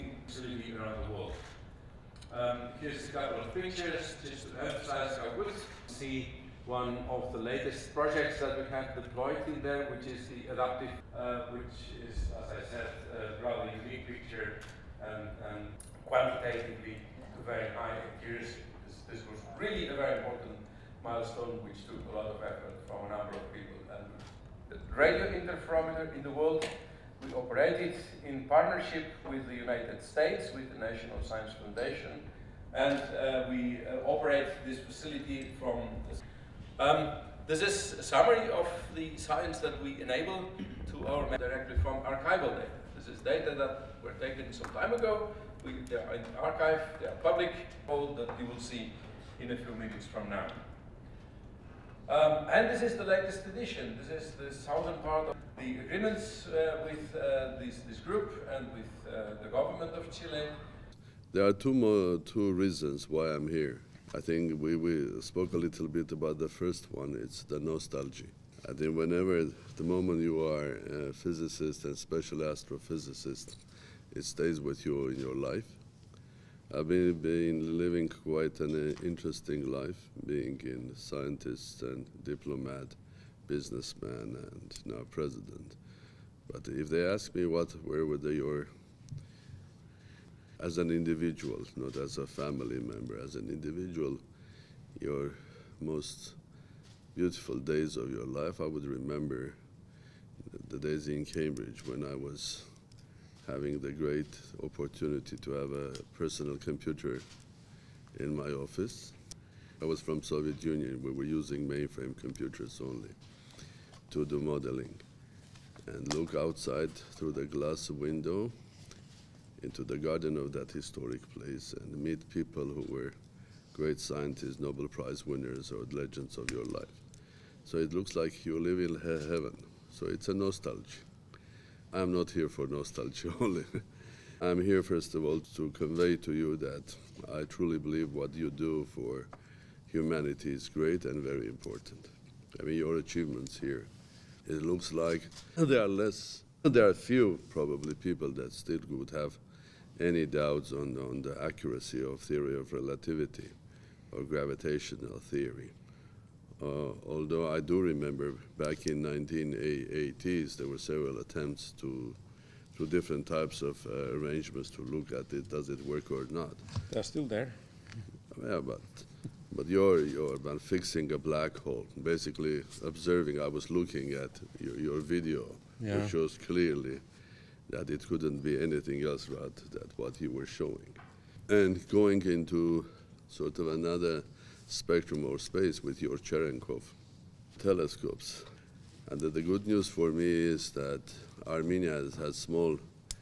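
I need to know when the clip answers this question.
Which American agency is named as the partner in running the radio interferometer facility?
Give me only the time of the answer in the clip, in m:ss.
0:30.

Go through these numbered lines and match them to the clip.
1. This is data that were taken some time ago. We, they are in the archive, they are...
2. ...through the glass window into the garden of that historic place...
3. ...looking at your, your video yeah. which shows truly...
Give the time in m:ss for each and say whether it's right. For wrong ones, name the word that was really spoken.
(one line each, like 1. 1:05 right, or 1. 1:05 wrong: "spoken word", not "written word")
1. 0:42 right
2. 1:57 right
3. 2:53 wrong: "clearly", not "truly".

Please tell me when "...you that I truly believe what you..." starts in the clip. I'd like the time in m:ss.
2:16.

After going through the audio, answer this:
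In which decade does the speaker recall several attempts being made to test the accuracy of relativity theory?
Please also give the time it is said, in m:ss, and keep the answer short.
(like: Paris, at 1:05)
1980s, at 2:39.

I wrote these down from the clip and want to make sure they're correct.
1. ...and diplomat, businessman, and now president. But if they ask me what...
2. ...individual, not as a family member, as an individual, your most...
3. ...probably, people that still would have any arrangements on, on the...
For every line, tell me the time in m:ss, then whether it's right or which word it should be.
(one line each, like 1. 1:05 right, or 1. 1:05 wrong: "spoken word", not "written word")
1. 1:21 right
2. 1:30 right
3. 2:27 wrong: "doubts", not "arrangements".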